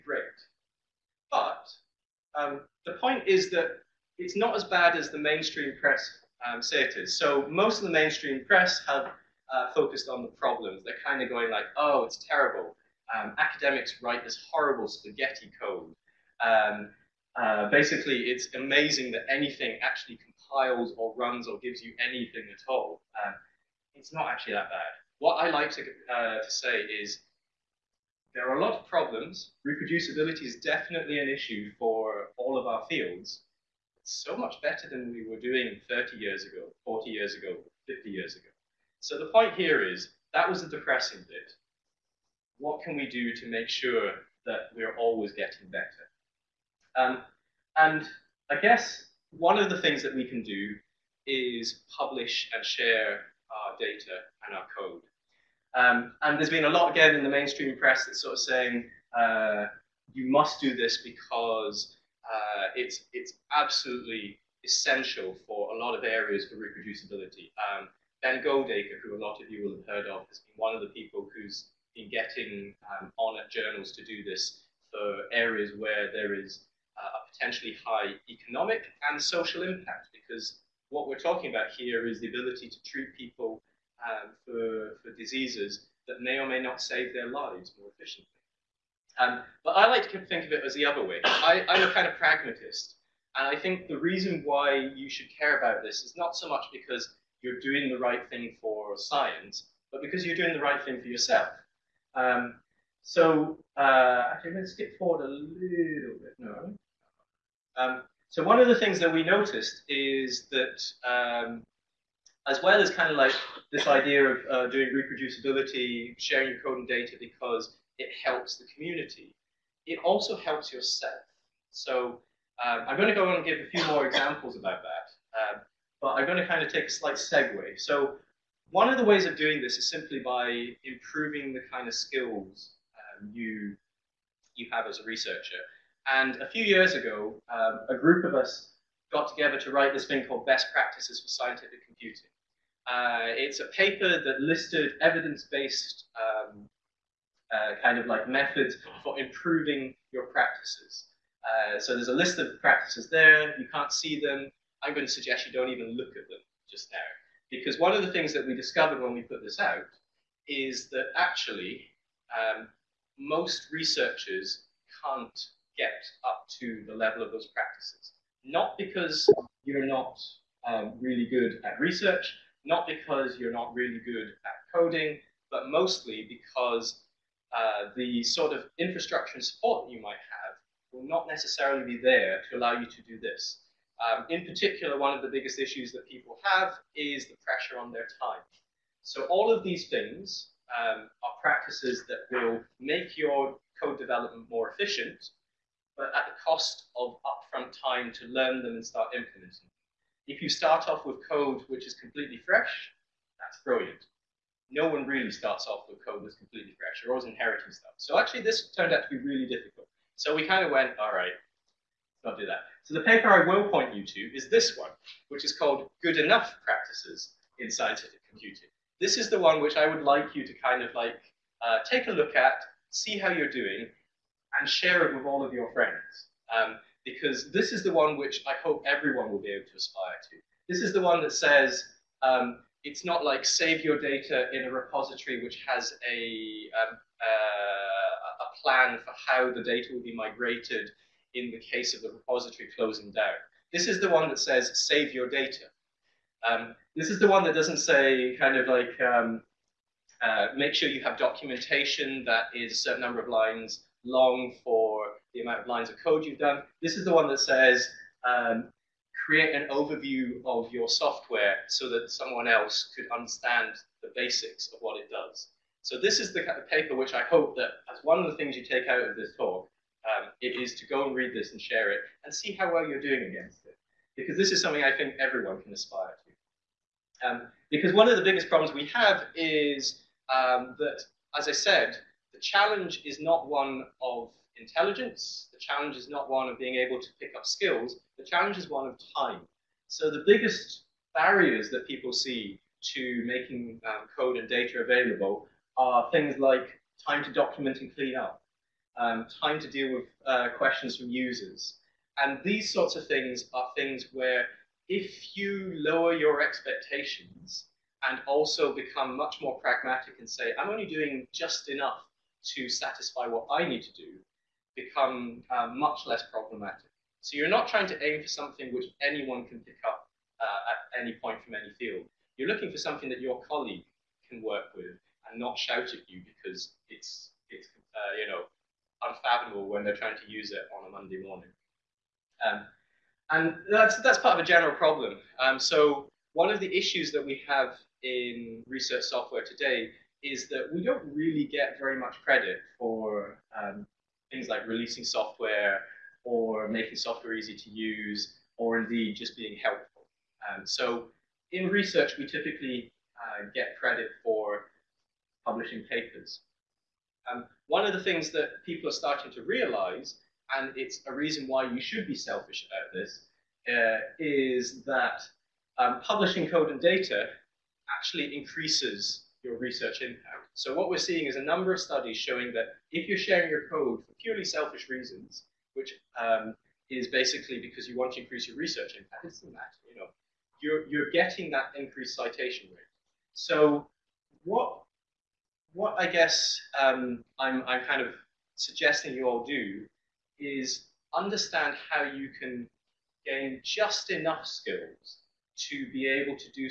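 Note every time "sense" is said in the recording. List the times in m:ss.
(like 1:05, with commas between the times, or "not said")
not said.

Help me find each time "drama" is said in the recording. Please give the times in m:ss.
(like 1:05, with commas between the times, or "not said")
not said.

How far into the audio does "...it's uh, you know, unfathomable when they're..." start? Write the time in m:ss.
5:27.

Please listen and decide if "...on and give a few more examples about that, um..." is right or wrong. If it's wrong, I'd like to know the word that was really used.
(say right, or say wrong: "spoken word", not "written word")
right.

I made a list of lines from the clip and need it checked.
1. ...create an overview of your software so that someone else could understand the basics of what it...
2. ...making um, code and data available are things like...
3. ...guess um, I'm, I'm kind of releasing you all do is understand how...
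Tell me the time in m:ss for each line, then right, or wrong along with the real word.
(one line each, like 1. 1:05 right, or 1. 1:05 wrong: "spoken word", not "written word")
1. 4:19 right
2. 4:53 right
3. 6:26 wrong: "suggesting", not "releasing".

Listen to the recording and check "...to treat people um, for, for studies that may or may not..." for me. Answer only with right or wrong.
wrong.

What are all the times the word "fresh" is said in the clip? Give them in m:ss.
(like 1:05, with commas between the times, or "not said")
3:22, 3:26.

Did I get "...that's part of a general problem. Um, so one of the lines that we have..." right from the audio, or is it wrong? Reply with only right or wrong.
wrong.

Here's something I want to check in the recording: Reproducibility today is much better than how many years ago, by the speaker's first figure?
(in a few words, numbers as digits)
30.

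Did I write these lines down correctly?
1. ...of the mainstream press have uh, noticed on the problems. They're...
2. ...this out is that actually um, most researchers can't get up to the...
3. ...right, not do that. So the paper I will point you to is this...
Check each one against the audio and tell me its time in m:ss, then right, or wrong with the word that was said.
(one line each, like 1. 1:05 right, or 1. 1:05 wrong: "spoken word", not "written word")
1. 0:07 wrong: "focused", not "noticed"
2. 2:39 right
3. 3:31 right.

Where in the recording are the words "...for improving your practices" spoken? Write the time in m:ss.
2:29.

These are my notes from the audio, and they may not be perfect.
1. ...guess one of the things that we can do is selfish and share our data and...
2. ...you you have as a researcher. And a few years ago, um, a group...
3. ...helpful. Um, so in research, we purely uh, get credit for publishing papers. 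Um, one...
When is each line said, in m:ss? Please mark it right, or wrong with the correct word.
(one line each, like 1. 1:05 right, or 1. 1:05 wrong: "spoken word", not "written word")
1. 0:48 wrong: "publish", not "selfish"
2. 2:13 right
3. 5:49 wrong: "typically", not "purely".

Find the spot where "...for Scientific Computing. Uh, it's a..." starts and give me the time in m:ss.
2:21.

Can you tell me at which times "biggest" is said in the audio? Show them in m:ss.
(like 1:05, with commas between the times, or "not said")
3:05, 4:38, 4:50.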